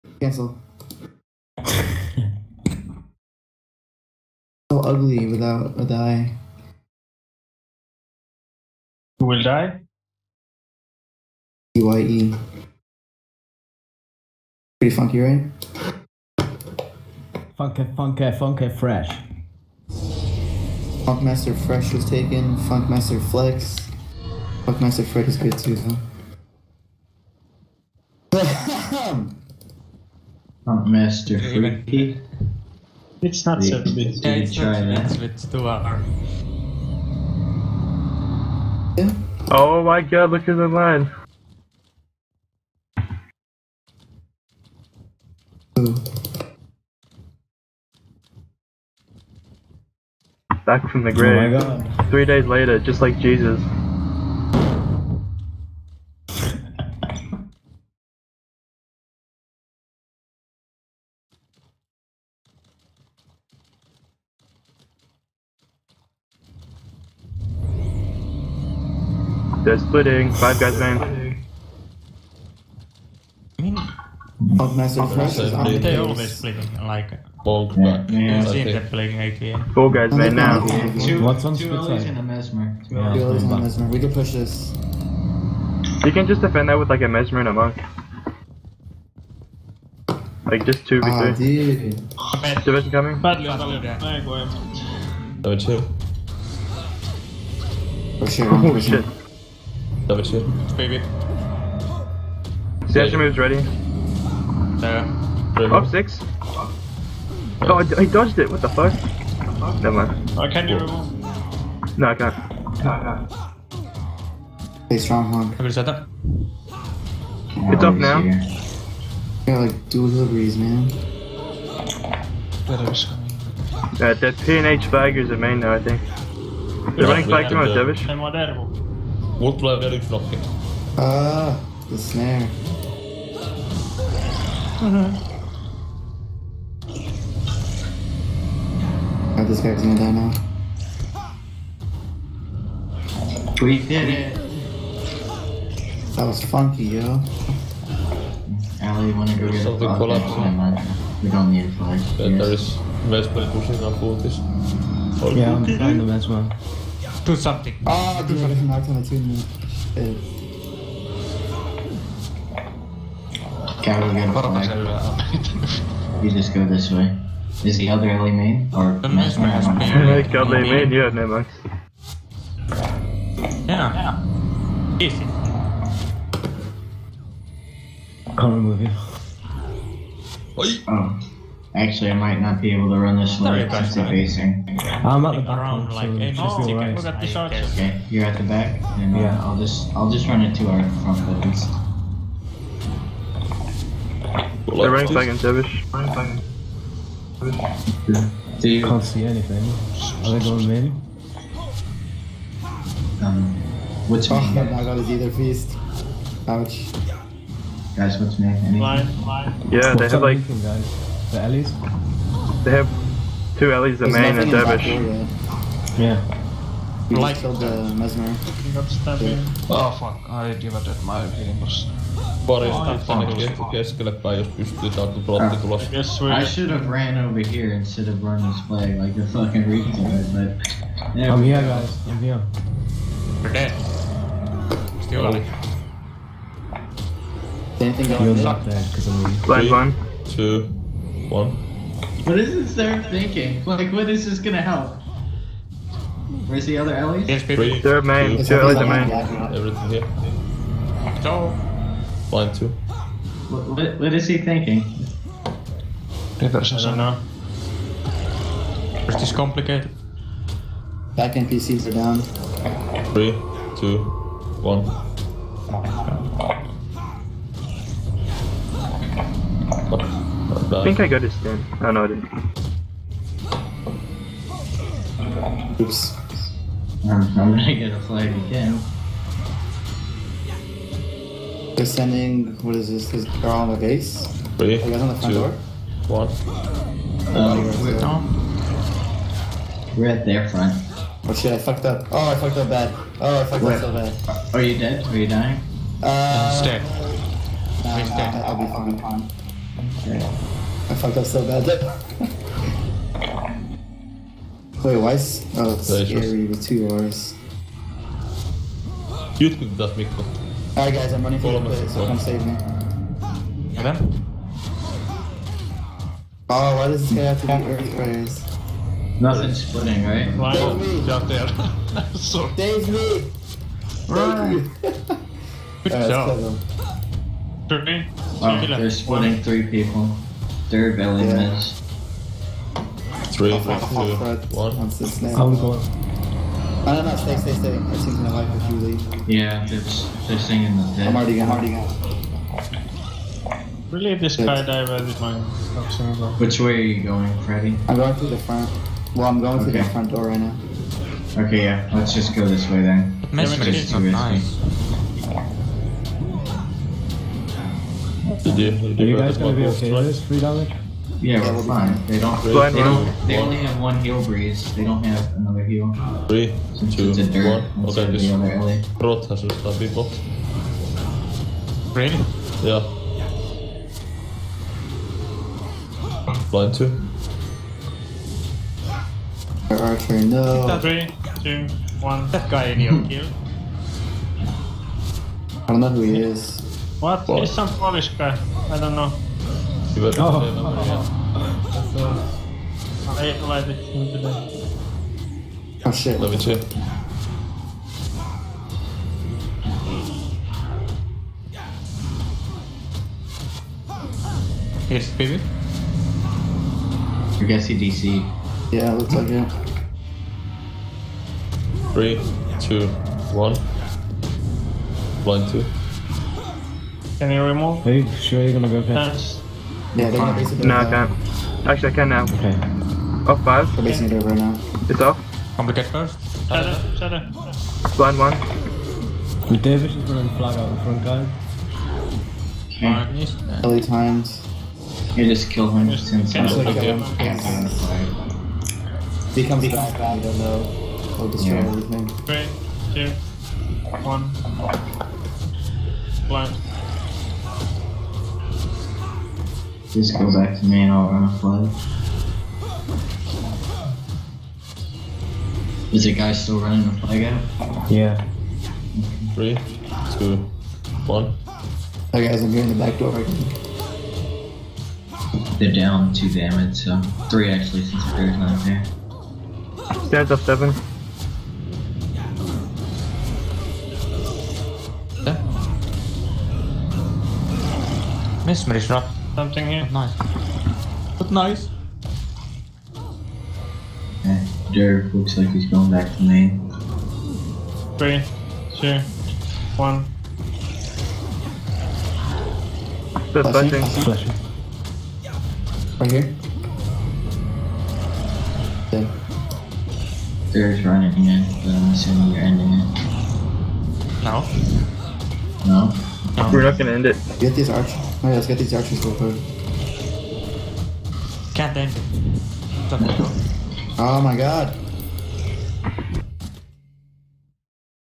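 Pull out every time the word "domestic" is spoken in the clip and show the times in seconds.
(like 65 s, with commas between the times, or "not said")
not said.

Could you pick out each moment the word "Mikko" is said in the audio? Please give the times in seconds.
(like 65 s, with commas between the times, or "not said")
309 s.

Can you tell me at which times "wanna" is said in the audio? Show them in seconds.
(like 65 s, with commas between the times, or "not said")
149 s.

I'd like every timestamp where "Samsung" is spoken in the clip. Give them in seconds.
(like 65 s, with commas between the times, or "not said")
not said.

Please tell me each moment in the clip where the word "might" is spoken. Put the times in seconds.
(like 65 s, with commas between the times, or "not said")
182 s.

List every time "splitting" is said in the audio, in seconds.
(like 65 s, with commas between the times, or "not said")
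69 s, 76 s, 319 s, 328 s.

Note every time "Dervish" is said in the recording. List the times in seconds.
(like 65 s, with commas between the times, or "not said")
127 s, 198 s, 214 s.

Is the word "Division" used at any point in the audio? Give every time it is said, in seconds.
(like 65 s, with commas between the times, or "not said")
92 s.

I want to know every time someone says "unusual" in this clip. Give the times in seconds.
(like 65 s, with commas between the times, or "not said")
not said.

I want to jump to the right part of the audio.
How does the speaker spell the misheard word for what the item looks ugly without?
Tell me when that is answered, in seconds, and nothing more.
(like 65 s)
11 s.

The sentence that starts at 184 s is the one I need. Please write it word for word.
I'm at the back, around, like, hey, just be right.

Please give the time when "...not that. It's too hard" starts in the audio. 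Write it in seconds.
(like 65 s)
34 s.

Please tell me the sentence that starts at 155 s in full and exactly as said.
Yeah, I'm trying best, Vespa to something.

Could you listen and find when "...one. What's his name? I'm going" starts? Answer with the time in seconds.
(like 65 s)
334 s.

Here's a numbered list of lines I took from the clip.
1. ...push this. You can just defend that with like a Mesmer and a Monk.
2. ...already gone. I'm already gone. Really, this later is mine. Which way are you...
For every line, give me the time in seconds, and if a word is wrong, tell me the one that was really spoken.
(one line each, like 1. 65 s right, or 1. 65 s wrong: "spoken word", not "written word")
1. 84 s right
2. 341 s wrong: "skydiver", not "later".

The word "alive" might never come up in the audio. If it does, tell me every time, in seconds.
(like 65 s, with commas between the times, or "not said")
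235 s.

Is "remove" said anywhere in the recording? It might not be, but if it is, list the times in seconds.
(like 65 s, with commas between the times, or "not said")
178 s, 417 s.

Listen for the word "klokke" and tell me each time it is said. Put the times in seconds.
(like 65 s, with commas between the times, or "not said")
130 s.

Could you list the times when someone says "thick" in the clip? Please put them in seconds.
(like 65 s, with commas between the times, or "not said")
not said.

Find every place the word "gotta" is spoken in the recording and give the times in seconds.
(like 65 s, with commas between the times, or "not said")
164 s, 204 s.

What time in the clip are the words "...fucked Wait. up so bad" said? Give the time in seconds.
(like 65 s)
293 s.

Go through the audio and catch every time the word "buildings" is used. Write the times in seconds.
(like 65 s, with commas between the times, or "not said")
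191 s, 330 s.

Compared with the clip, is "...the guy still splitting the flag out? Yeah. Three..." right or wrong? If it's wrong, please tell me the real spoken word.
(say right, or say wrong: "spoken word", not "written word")
wrong: "running", not "splitting".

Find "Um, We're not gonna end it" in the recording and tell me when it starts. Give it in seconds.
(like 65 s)
506 s.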